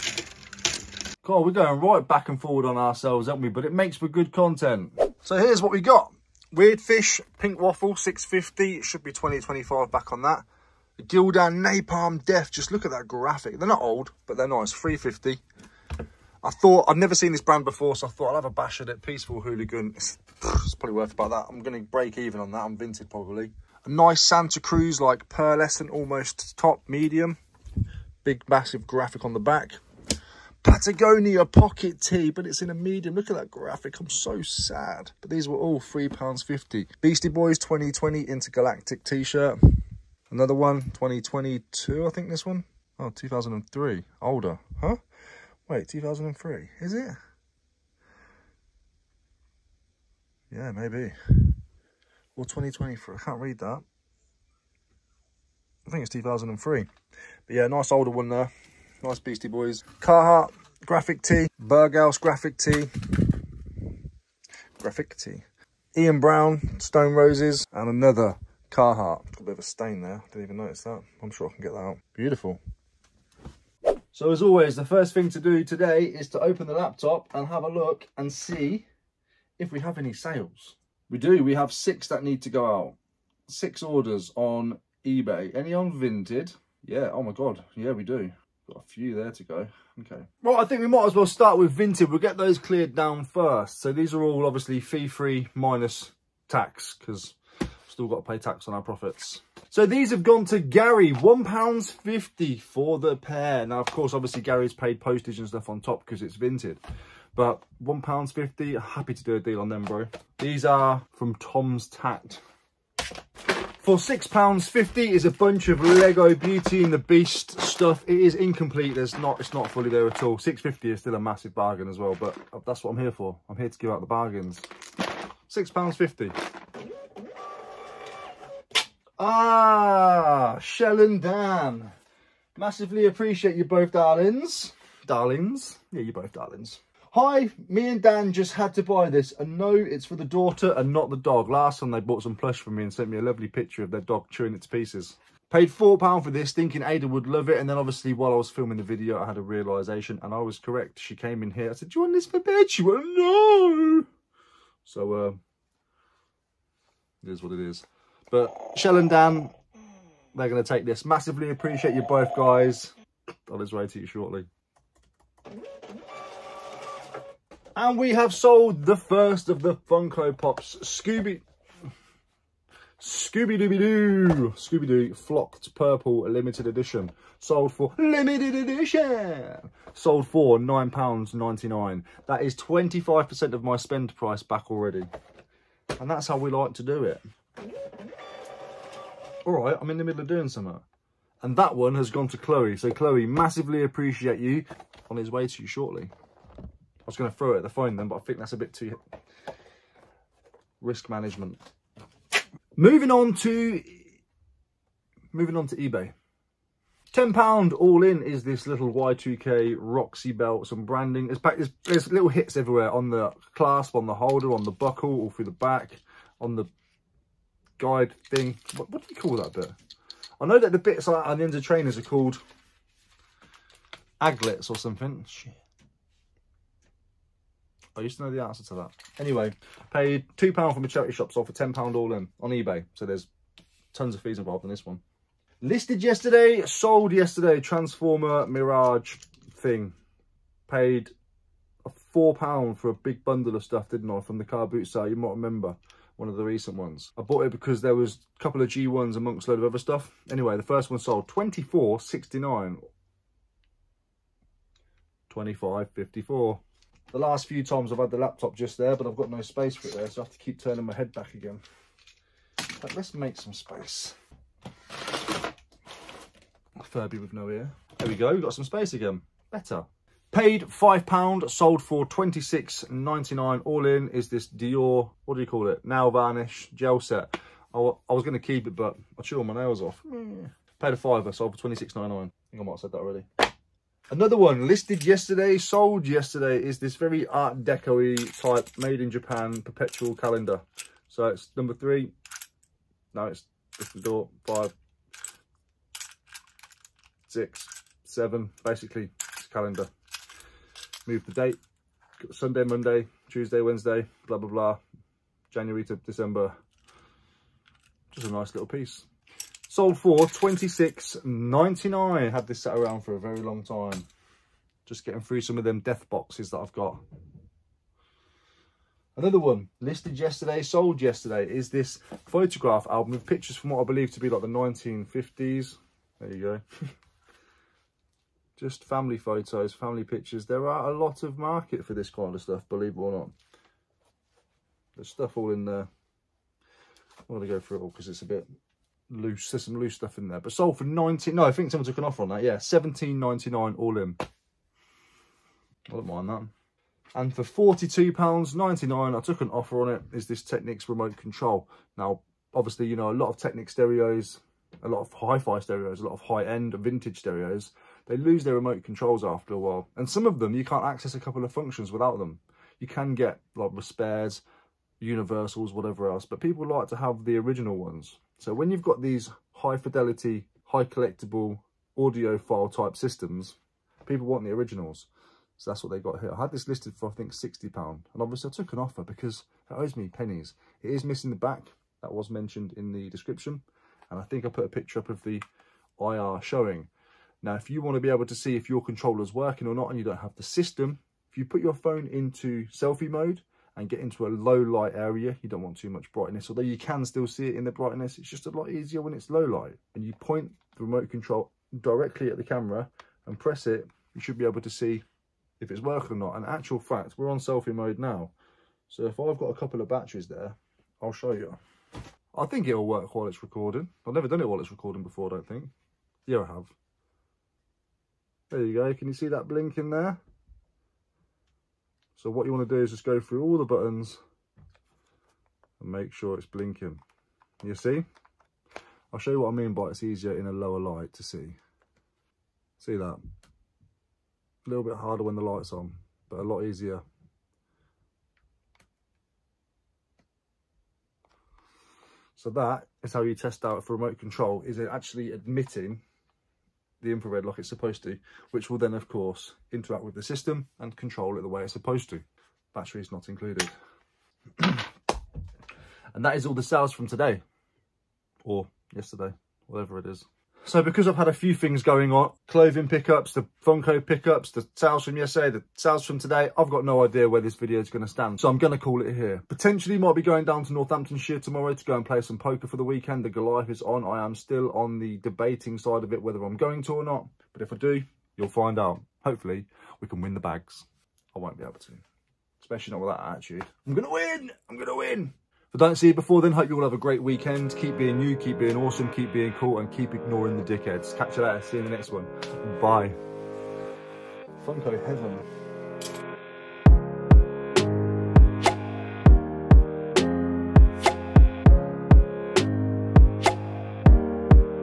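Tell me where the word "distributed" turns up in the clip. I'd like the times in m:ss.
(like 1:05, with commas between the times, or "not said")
not said.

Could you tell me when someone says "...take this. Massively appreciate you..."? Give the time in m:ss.
2:40.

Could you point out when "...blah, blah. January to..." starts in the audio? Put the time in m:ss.
5:04.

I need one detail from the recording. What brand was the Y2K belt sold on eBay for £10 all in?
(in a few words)
Roxy.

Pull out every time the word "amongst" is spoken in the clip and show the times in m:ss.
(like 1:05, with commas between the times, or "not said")
4:09.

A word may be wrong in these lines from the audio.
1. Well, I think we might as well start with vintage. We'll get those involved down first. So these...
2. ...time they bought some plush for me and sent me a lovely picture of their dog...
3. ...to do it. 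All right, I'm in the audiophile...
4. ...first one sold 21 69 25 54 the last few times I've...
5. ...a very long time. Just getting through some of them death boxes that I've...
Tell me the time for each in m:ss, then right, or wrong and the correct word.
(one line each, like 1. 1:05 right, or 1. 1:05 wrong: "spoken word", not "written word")
1. 1:30 wrong: "cleared", not "involved"
2. 2:21 right
3. 3:06 wrong: "middle", not "audiophile"
4. 4:10 wrong: "24", not "21"
5. 5:13 right.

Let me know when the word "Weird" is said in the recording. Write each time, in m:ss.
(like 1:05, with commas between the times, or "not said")
0:06.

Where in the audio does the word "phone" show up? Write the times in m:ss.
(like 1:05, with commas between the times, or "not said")
3:17, 6:31.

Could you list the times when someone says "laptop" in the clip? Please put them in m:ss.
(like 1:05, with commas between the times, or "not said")
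1:16, 4:18.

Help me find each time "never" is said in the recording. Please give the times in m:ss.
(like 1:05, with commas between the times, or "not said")
0:16, 6:54.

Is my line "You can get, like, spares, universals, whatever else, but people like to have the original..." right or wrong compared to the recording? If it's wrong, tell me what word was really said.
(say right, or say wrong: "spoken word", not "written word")
right.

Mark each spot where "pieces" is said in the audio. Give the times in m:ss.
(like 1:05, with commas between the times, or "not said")
2:24, 5:08.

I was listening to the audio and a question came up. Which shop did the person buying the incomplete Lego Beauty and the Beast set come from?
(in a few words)
Tom's Tat.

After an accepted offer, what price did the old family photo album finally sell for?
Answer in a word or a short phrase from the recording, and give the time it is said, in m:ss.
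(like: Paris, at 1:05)
17.99, at 5:42.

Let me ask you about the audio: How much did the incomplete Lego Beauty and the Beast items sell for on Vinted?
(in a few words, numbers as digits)
£6.50.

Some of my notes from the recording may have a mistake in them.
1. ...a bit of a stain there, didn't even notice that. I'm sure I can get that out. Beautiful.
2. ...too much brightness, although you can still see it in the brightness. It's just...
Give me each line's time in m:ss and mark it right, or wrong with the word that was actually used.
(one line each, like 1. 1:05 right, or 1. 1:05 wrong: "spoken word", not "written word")
1. 1:09 right
2. 6:35 right.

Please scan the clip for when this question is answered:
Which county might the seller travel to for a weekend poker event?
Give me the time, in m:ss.
7:50.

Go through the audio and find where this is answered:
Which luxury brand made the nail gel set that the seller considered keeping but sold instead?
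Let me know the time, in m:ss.
4:34.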